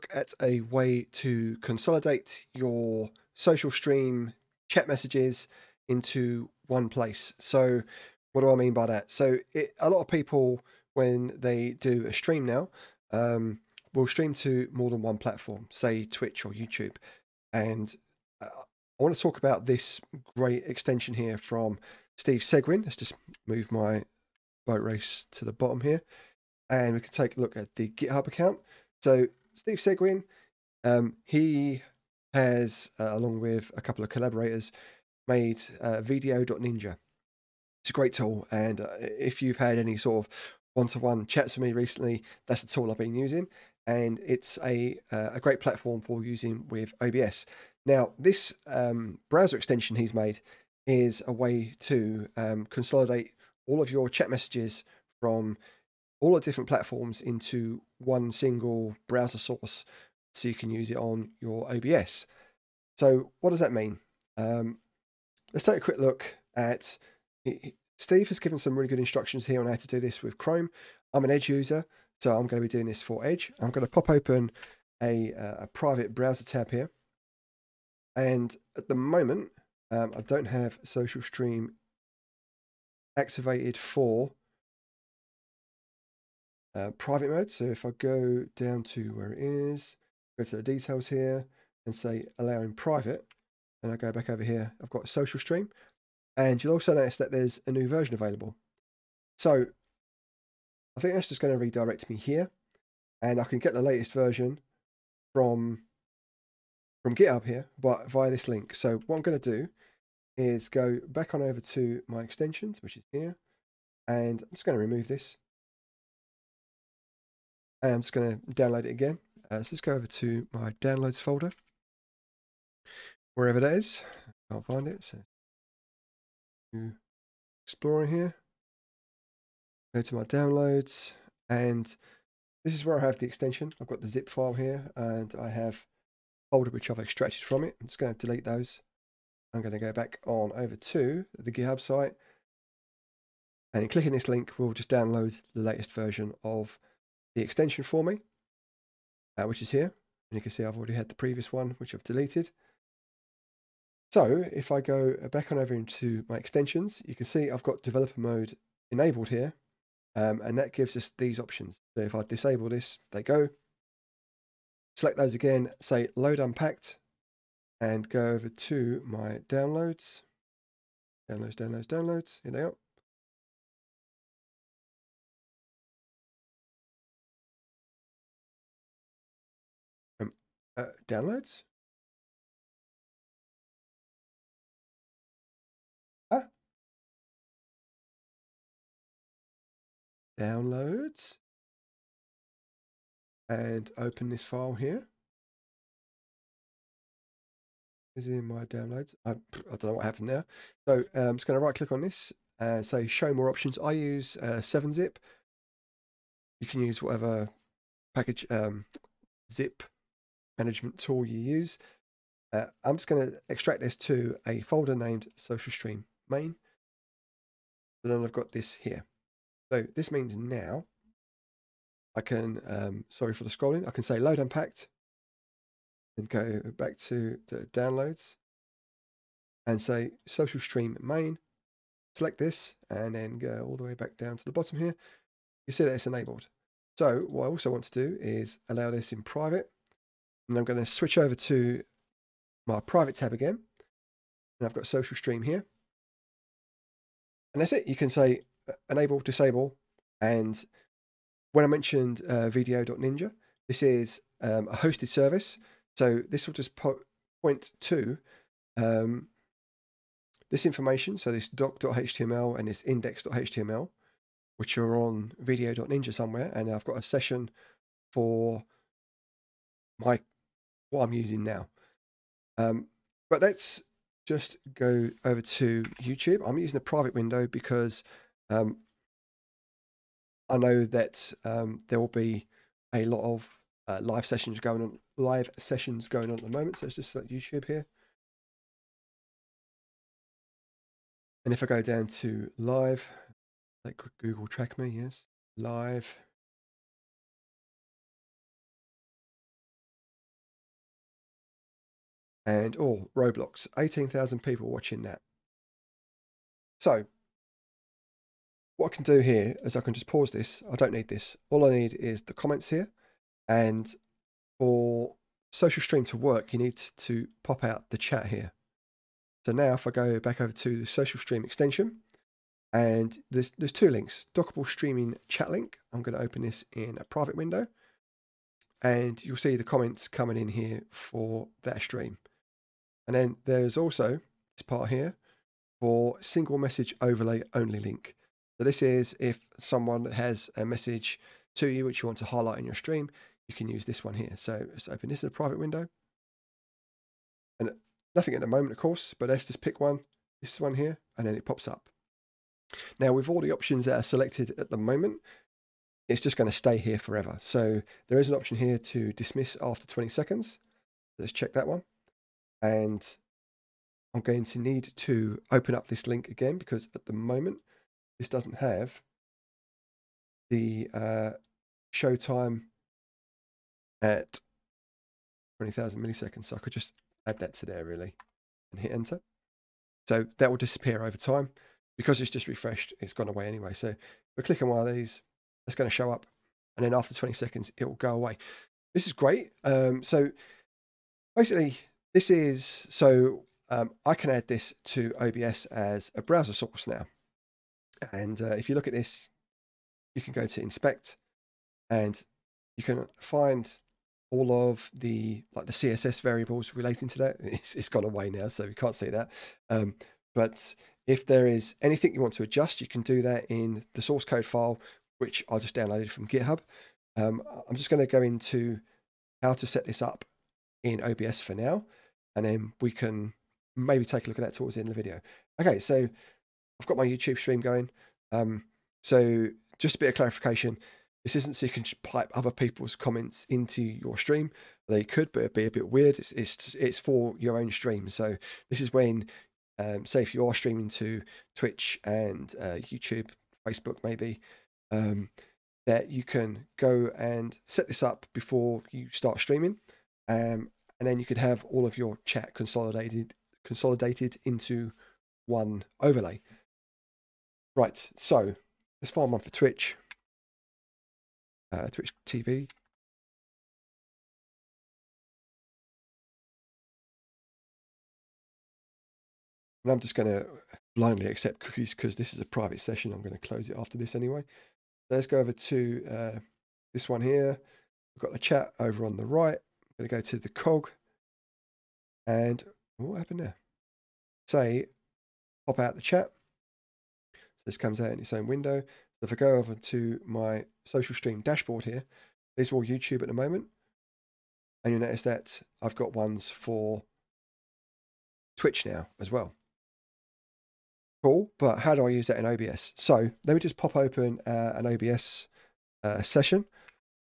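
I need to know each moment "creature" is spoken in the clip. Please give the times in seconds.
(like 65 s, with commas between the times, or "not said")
not said.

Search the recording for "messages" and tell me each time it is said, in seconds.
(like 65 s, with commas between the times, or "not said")
4 s, 54 s, 336 s, 340 s.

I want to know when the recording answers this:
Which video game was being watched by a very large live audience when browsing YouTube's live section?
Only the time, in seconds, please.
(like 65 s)
303 s.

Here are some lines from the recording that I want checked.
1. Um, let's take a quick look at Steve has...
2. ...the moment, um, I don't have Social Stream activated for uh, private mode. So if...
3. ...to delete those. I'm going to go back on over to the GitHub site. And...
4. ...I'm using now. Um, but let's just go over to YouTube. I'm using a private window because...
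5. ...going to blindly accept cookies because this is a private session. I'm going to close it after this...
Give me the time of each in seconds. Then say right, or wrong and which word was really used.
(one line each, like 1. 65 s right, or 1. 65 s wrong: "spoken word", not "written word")
1. 64 s right
2. 78 s right
3. 138 s right
4. 271 s right
5. 470 s right.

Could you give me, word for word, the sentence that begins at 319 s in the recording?
So now if I go back over to the social stream extension, and there's, there's two links, dockable streaming chat link.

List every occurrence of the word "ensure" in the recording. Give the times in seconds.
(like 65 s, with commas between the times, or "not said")
not said.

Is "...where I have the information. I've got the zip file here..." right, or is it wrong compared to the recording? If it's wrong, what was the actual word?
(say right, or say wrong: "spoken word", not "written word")
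wrong: "extension", not "information".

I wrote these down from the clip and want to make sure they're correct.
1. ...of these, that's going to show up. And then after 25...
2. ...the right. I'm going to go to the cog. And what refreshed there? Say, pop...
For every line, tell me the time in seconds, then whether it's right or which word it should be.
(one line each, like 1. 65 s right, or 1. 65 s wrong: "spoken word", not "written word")
1. 384 s wrong: "20", not "25"
2. 479 s wrong: "happened", not "refreshed".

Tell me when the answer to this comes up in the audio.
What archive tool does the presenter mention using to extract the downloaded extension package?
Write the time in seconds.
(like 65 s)
204 s.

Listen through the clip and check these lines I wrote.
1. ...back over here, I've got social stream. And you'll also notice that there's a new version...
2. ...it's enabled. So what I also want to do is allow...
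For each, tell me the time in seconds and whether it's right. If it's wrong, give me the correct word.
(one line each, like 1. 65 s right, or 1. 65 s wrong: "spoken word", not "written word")
1. 94 s right
2. 235 s right.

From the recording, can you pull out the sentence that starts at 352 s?
Now, with all the options that are selected at the moment, it's just going to stay here forever.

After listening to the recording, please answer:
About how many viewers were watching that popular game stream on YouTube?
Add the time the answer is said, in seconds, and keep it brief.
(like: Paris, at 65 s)
18,000, at 303 s.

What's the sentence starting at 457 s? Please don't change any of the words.
Right, so let's find one for Twitch uh, Twitch TV.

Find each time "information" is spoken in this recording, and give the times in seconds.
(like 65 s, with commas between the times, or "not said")
260 s.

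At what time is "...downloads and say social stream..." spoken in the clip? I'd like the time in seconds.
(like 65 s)
227 s.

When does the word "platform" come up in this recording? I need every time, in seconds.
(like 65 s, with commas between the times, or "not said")
15 s, 45 s, 56 s.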